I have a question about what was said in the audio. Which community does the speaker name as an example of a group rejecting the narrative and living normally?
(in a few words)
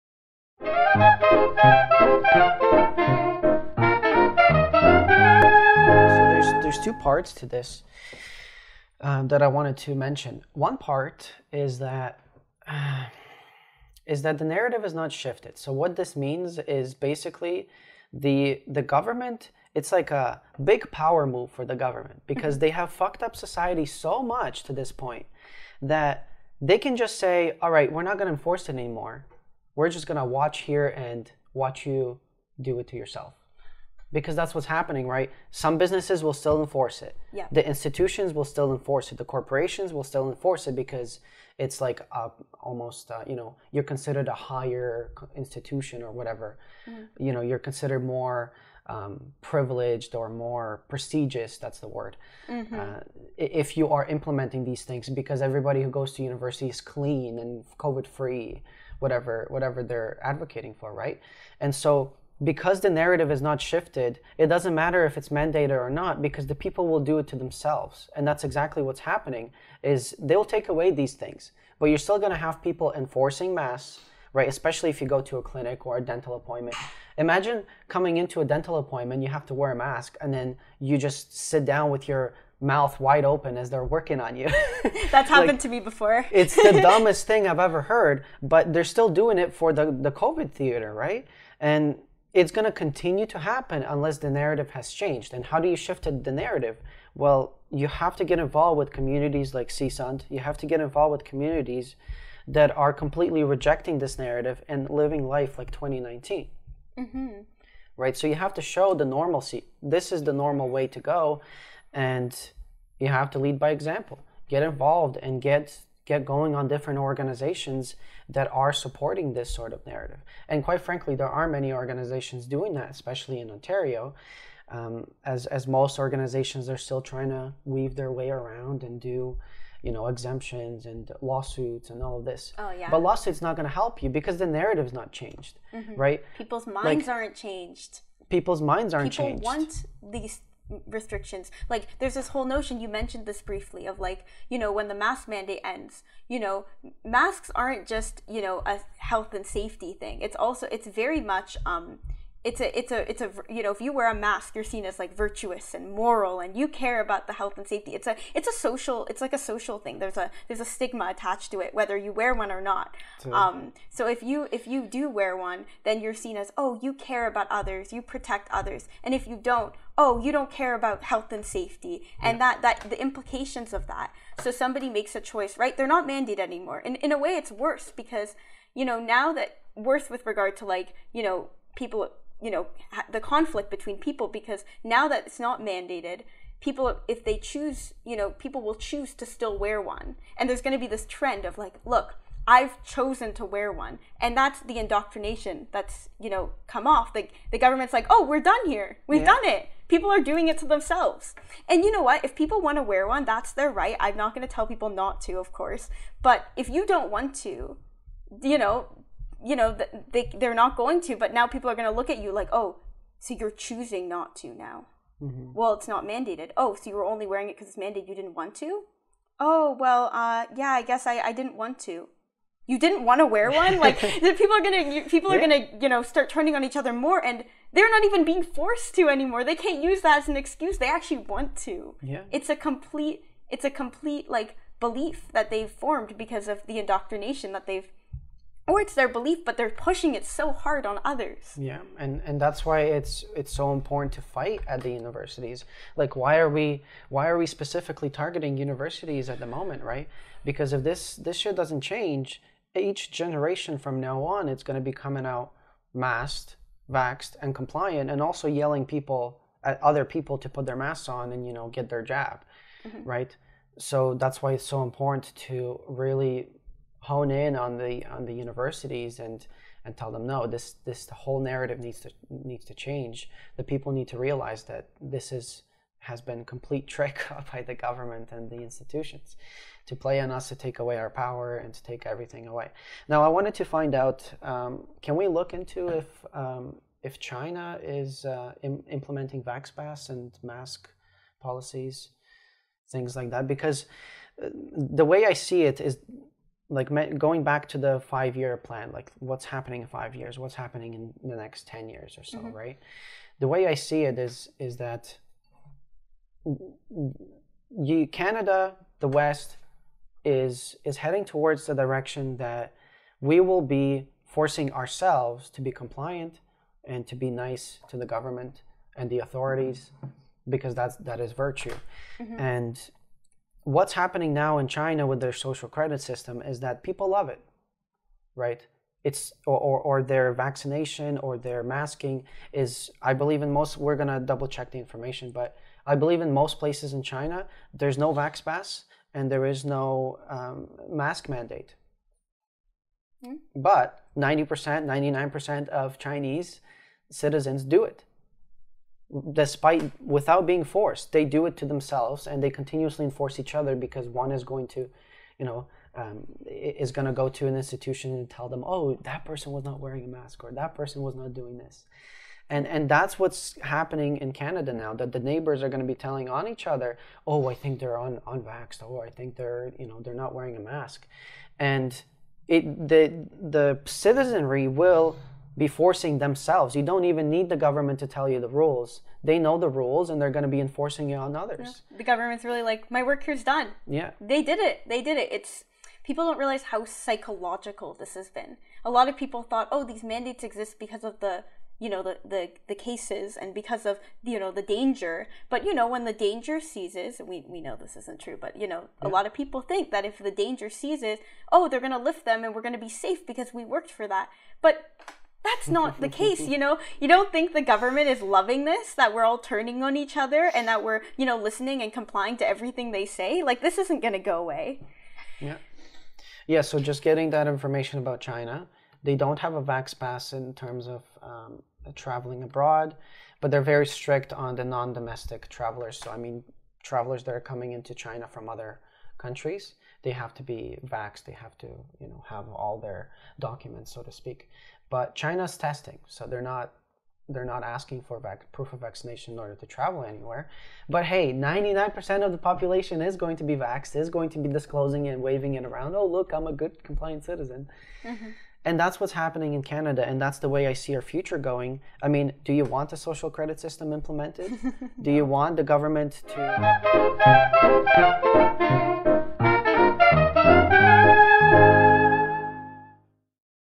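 CSONT.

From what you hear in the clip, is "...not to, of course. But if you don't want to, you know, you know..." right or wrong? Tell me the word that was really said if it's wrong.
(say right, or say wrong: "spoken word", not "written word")
right.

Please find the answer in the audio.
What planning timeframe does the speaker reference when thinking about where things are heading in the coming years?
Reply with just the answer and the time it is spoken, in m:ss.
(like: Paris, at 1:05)
Five year plan, at 4:57.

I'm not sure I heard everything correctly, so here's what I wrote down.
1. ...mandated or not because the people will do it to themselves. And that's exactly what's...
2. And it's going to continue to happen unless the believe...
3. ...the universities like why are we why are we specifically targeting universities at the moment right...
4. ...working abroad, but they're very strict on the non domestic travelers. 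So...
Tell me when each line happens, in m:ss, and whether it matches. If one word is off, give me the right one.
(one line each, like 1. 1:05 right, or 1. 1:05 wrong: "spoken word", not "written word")
1. 1:05 right
2. 1:31 wrong: "narrative", not "believe"
3. 4:04 right
4. 7:01 wrong: "traveling", not "working".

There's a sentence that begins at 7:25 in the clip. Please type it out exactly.
Oh, look, I'm a good compliant citizen.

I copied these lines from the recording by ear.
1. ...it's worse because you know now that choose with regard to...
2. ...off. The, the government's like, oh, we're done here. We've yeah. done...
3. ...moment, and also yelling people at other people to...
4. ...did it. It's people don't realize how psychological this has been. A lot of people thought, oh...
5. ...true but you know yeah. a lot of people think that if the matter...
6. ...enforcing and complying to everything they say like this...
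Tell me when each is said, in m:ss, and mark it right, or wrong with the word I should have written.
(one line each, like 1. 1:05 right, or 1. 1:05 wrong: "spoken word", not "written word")
1. 2:57 wrong: "worse", not "choose"
2. 3:16 right
3. 4:17 wrong: "compliant", not "moment"
4. 6:25 right
5. 6:38 wrong: "danger", not "matter"
6. 6:51 wrong: "listening", not "enforcing".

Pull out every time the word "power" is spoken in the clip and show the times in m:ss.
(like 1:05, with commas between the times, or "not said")
0:20, 4:41.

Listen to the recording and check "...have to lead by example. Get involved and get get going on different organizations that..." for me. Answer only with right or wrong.
right.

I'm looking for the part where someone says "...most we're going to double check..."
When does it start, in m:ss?
5:33.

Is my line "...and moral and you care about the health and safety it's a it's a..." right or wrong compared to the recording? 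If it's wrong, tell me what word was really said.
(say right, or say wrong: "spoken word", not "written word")
right.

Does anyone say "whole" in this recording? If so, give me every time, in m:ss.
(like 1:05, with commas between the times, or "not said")
2:22, 4:31.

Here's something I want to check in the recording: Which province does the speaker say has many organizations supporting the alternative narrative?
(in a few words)
Ontario.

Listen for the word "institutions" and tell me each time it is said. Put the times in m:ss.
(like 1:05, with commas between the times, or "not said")
0:37, 0:45, 4:38, 5:57.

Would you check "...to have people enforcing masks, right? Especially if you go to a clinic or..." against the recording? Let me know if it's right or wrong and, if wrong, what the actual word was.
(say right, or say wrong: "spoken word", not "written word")
right.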